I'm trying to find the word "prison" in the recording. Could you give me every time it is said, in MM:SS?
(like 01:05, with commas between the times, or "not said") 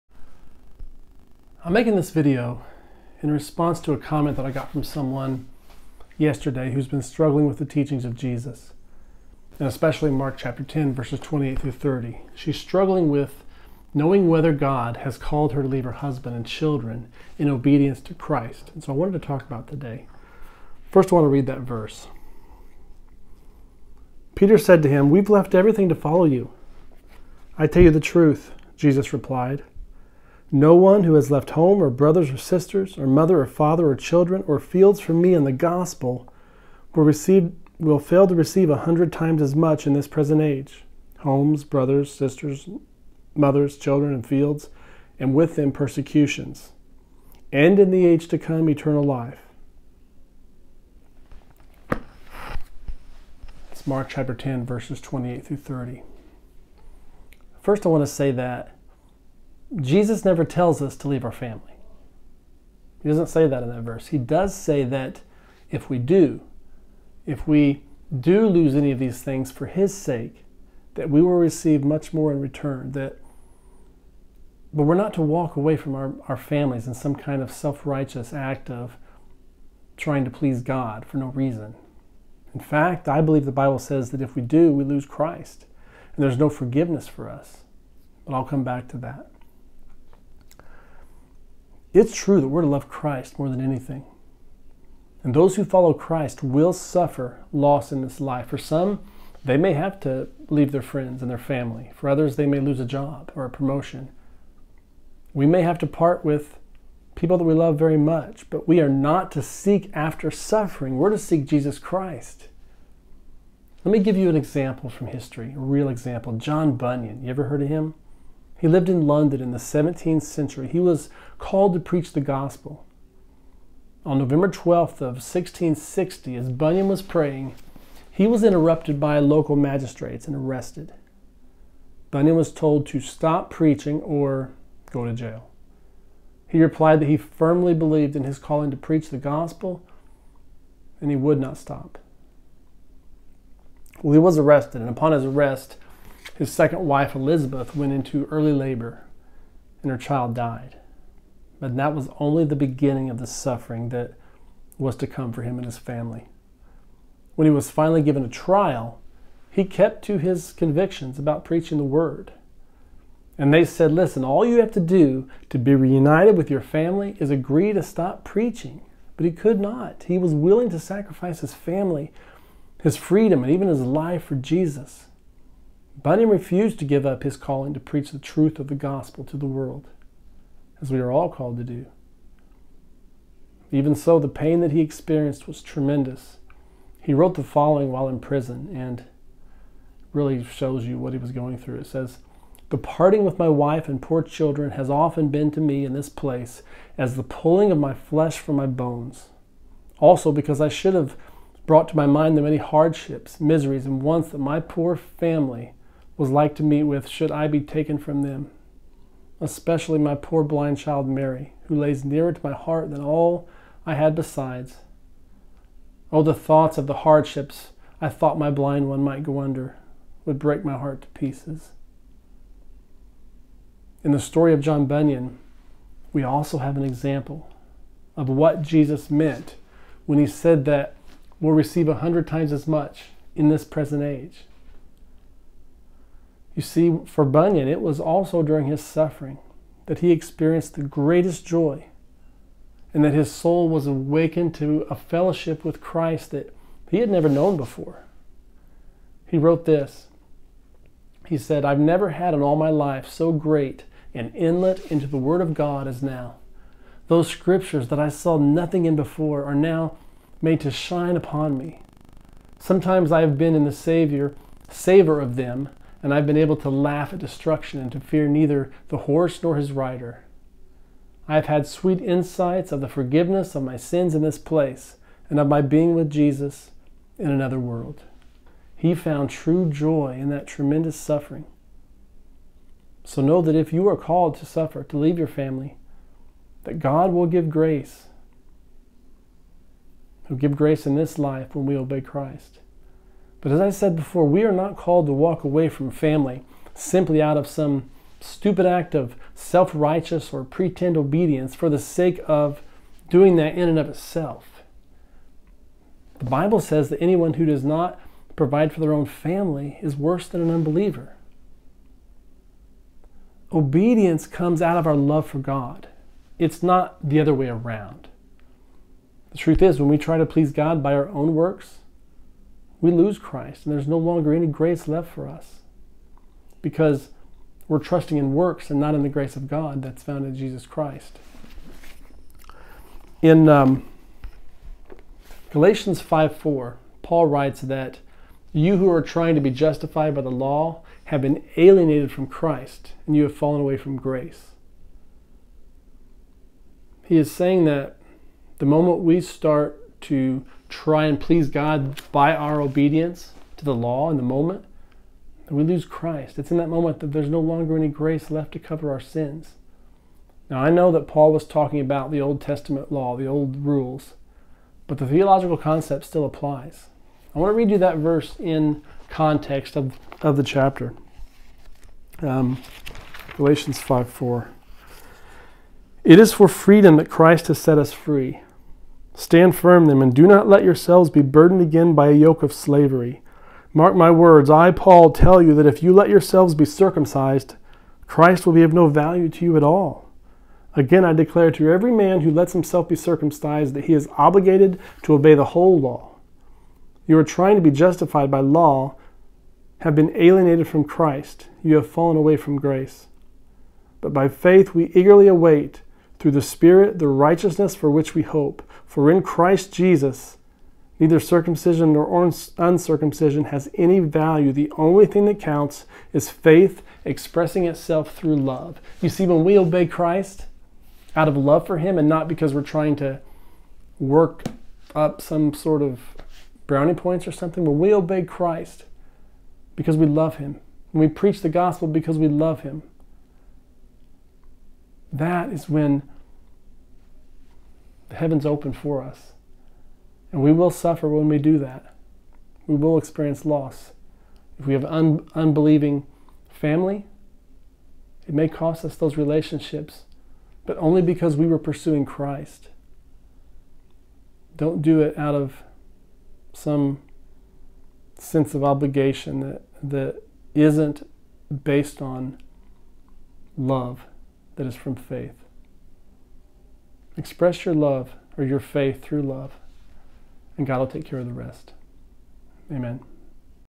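03:08.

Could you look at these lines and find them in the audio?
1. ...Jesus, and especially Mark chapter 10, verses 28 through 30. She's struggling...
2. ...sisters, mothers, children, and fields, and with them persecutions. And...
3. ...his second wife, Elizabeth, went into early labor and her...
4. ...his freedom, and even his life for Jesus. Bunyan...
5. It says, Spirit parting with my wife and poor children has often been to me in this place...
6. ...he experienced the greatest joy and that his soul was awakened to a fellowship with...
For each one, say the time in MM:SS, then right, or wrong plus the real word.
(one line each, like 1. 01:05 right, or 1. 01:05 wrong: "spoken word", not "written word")
1. 00:08 right
2. 00:42 right
3. 02:26 right
4. 02:52 right
5. 03:11 wrong: "The", not "Spirit"
6. 03:59 right.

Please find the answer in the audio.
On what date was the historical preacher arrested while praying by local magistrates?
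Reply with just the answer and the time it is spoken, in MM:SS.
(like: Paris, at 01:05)
November 12, 1660, at 02:04.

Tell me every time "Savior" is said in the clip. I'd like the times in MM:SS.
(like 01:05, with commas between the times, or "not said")
04:23.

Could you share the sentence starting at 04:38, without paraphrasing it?
He found true joy in that tremendous suffering.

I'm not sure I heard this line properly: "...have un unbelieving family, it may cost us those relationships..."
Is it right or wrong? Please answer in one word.
right.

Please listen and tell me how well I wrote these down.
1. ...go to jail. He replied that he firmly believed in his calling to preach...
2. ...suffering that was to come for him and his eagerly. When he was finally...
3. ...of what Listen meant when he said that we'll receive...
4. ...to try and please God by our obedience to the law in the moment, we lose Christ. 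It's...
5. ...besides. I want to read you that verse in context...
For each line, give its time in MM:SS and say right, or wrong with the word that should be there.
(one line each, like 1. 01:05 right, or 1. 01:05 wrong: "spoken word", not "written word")
1. 02:14 right
2. 02:33 wrong: "family", not "eagerly"
3. 03:48 wrong: "Jesus", not "Listen"
4. 05:50 right
5. 06:06 wrong: "applies", not "besides".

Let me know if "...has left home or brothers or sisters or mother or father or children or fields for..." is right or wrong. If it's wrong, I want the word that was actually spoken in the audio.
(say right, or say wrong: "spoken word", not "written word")
right.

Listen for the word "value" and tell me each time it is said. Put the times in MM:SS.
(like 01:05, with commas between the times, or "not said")
06:28, 06:53.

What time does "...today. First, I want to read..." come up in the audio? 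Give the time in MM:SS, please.
00:19.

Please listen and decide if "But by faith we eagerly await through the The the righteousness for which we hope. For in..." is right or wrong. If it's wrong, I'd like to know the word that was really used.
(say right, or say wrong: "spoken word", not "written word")
wrong: "Spirit", not "The".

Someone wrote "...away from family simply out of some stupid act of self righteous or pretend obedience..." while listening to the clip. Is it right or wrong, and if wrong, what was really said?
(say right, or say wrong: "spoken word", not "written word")
right.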